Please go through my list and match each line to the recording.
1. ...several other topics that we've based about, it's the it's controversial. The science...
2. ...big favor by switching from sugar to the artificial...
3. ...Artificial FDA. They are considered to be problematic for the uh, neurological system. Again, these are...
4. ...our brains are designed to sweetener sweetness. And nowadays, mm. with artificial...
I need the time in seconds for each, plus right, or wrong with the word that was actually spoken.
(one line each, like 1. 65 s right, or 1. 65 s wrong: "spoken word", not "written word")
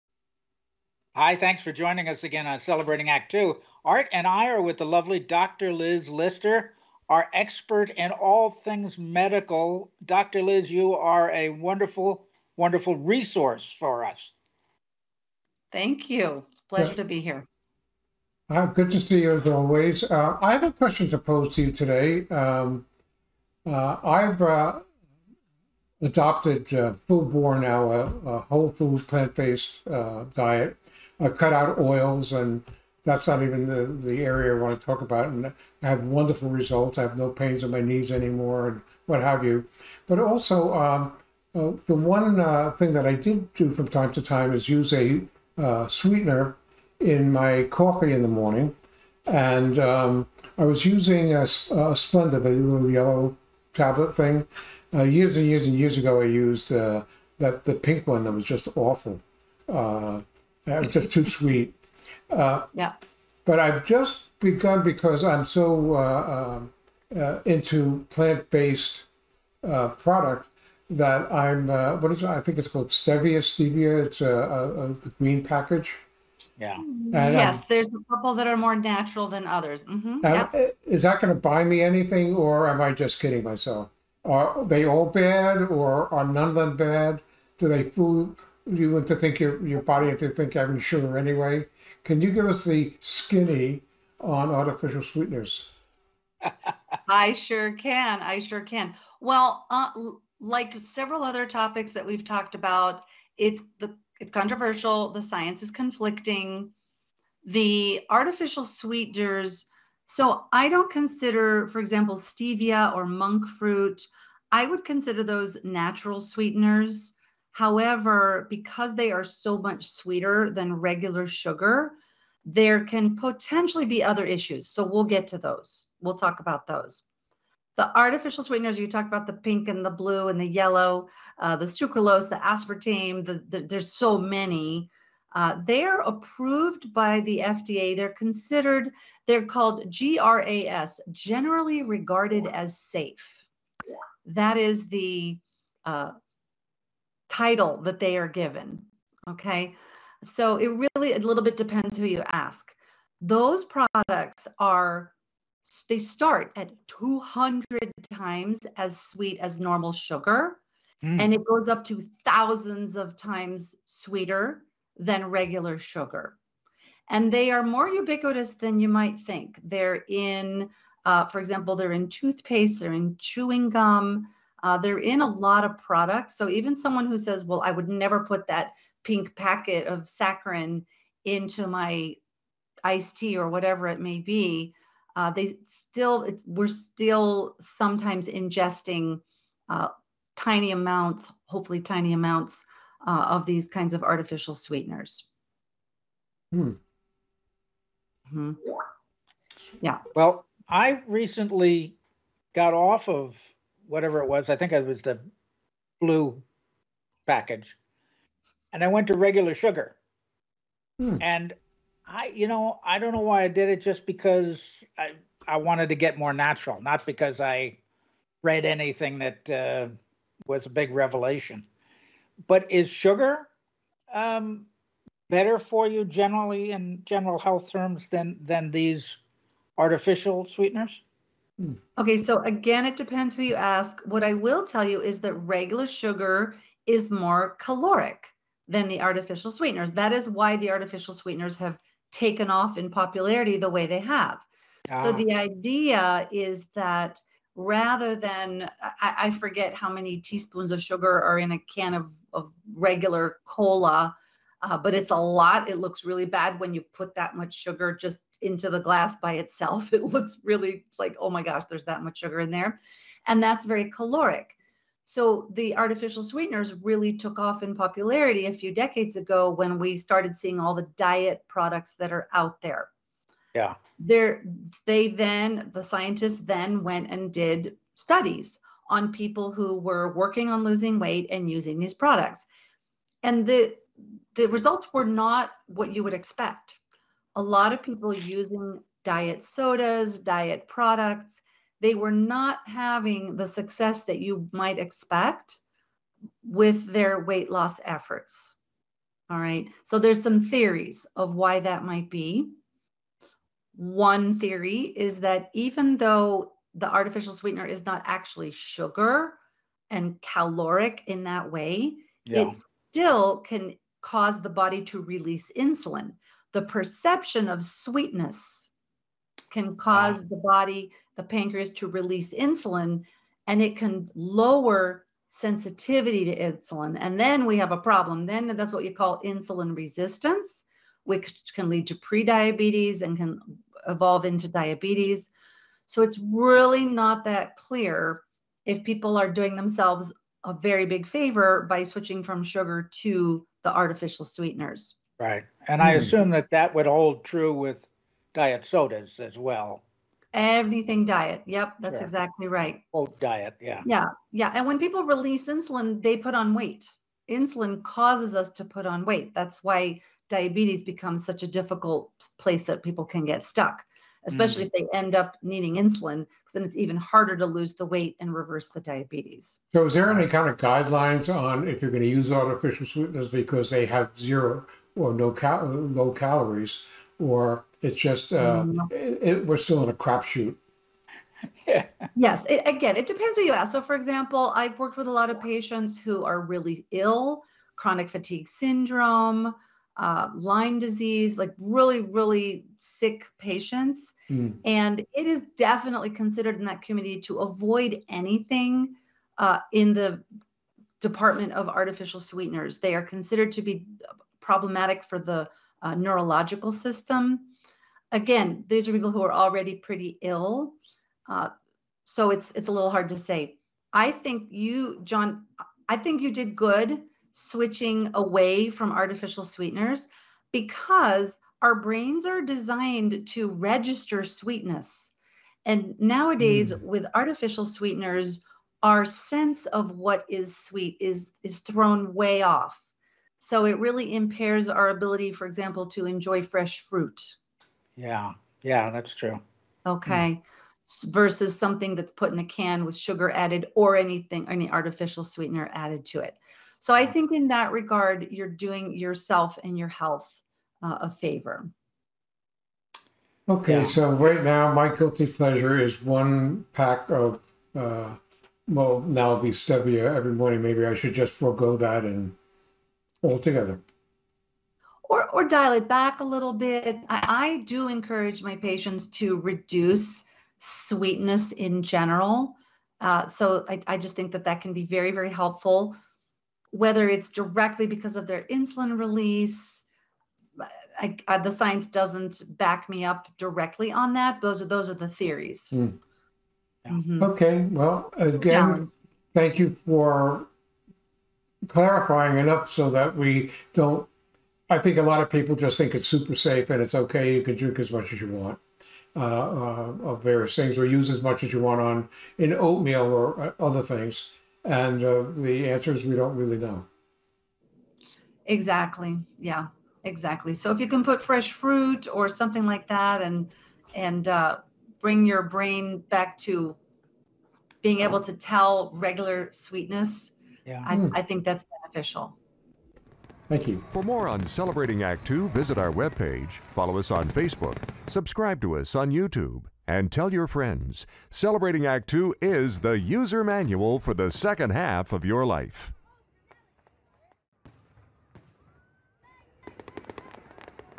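1. 100 s wrong: "talked", not "based"
2. 340 s right
3. 401 s wrong: "Sweeteners", not "FDA"
4. 421 s wrong: "register", not "sweetener".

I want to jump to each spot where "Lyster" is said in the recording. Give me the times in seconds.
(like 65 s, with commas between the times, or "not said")
6 s.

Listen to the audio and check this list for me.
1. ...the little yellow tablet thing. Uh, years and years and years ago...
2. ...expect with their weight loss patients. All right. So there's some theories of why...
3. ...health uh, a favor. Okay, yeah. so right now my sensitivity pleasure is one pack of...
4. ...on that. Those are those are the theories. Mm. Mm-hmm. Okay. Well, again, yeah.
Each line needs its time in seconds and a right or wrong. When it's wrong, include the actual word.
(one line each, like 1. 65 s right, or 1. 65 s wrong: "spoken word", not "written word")
1. 52 s right
2. 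294 s wrong: "efforts", not "patients"
3. 449 s wrong: "guilty", not "sensitivity"
4. 483 s right.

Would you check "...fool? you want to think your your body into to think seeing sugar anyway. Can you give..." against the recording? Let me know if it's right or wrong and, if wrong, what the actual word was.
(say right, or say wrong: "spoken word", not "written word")
wrong: "having", not "seeing".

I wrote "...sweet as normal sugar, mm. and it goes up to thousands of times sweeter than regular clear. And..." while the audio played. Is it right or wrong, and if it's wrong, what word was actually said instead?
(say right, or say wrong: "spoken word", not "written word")
wrong: "sugar", not "clear".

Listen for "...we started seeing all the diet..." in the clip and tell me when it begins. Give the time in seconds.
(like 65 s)
269 s.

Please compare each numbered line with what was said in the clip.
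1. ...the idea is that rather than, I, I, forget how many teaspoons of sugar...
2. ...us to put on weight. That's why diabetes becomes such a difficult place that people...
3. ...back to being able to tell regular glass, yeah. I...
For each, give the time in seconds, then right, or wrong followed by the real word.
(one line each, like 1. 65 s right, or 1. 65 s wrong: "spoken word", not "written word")
1. 245 s right
2. 358 s right
3. 516 s wrong: "sweetness", not "glass".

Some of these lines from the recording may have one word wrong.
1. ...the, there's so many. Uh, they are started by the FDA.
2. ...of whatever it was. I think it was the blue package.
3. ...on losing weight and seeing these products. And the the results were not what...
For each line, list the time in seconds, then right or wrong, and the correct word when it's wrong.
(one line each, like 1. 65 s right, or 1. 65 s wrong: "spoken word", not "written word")
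1. 133 s wrong: "approved", not "started"
2. 203 s right
3. 280 s wrong: "using", not "seeing".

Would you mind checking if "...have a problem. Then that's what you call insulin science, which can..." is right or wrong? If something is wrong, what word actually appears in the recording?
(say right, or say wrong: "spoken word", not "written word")
wrong: "resistance", not "science".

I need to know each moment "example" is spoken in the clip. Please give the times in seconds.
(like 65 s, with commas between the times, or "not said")
111 s, 171 s, 383 s, 435 s.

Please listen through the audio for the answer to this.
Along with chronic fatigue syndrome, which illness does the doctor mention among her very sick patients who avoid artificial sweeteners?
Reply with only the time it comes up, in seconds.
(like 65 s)
390 s.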